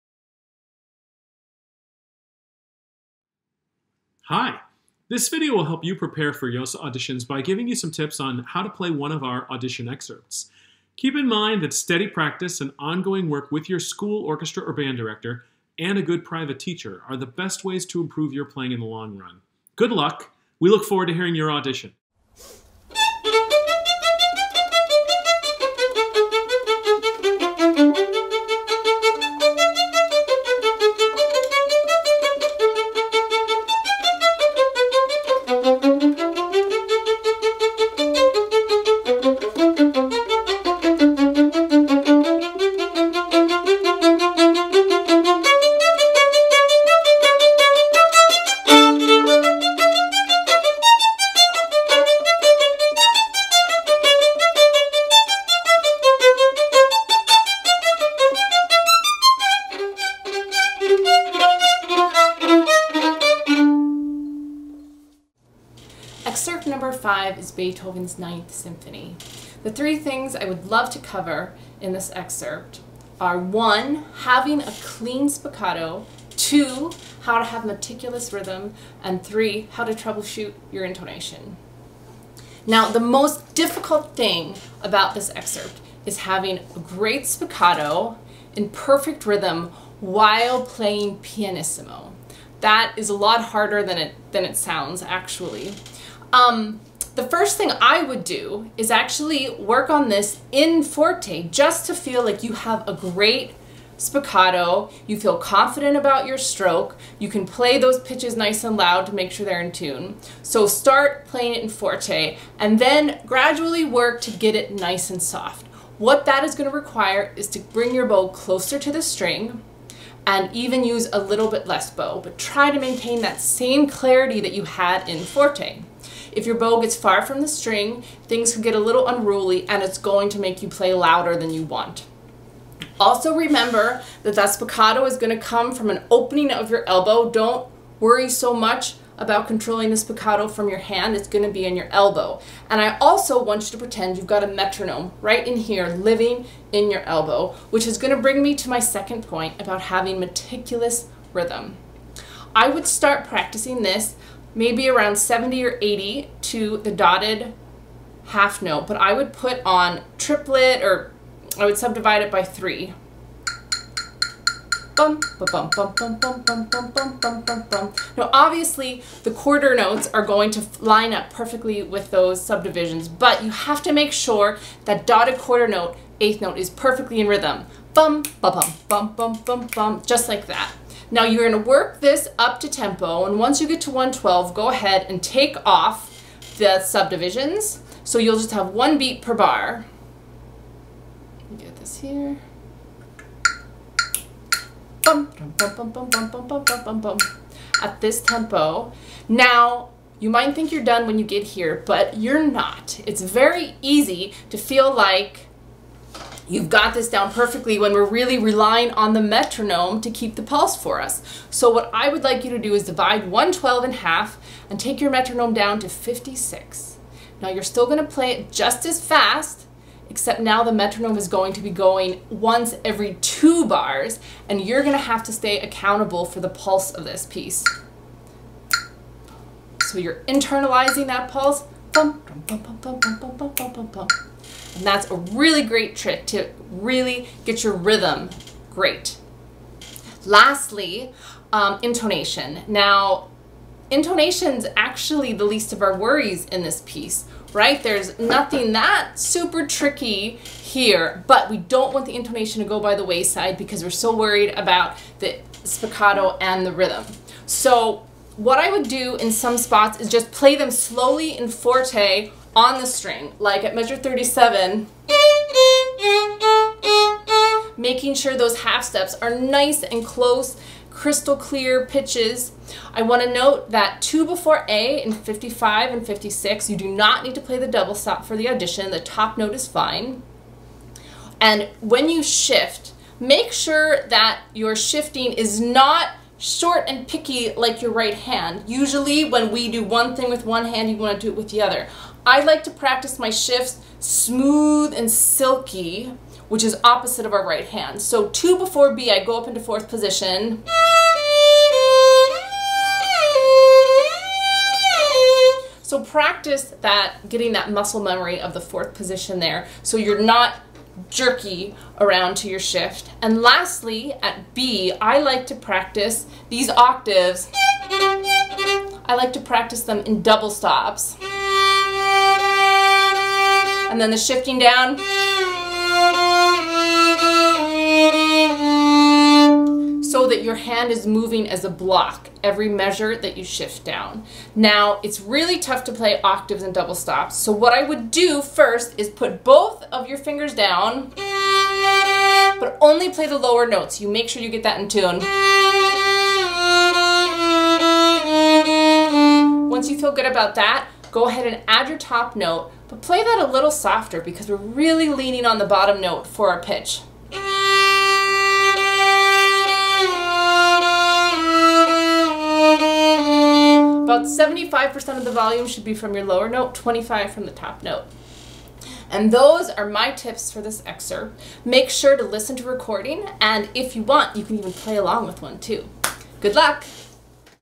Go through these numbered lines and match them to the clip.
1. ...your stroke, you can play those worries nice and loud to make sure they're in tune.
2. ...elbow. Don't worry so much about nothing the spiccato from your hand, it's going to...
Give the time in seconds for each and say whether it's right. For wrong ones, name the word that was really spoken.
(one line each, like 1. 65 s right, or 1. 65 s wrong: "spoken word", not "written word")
1. 106 s wrong: "pitches", not "worries"
2. 136 s wrong: "controlling", not "nothing".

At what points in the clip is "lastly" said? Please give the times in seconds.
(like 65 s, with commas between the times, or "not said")
240 s, 313 s.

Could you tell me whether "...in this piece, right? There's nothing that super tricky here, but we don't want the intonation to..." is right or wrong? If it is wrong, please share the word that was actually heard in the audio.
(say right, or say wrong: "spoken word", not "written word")
right.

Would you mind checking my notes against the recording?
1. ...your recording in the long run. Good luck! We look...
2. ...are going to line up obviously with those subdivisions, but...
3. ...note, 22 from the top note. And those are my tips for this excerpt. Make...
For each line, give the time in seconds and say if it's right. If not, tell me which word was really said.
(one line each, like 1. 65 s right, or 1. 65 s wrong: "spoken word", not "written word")
1. 18 s wrong: "playing", not "recording"
2. 170 s wrong: "perfectly", not "obviously"
3. 366 s wrong: "25", not "22".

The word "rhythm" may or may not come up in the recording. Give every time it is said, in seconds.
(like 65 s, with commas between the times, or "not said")
78 s, 89 s, 151 s, 177 s, 237 s, 256 s.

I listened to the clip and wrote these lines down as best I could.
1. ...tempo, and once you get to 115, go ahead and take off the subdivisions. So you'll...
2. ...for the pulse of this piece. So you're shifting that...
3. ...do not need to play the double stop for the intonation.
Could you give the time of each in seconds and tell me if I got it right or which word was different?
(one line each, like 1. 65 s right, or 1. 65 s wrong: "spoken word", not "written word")
1. 182 s wrong: "112", not "115"
2. 226 s wrong: "internalizing", not "shifting"
3. 276 s wrong: "audition", not "intonation".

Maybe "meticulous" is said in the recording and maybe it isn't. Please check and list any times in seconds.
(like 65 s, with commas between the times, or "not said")
77 s, 150 s.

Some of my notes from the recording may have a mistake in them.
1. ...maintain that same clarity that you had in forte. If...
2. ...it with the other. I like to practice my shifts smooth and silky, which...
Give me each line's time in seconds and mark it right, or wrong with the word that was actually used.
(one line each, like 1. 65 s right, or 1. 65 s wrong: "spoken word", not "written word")
1. 122 s right
2. 291 s right.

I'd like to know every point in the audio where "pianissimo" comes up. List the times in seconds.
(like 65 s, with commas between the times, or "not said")
91 s.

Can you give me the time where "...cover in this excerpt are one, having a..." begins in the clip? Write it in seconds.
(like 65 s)
70 s.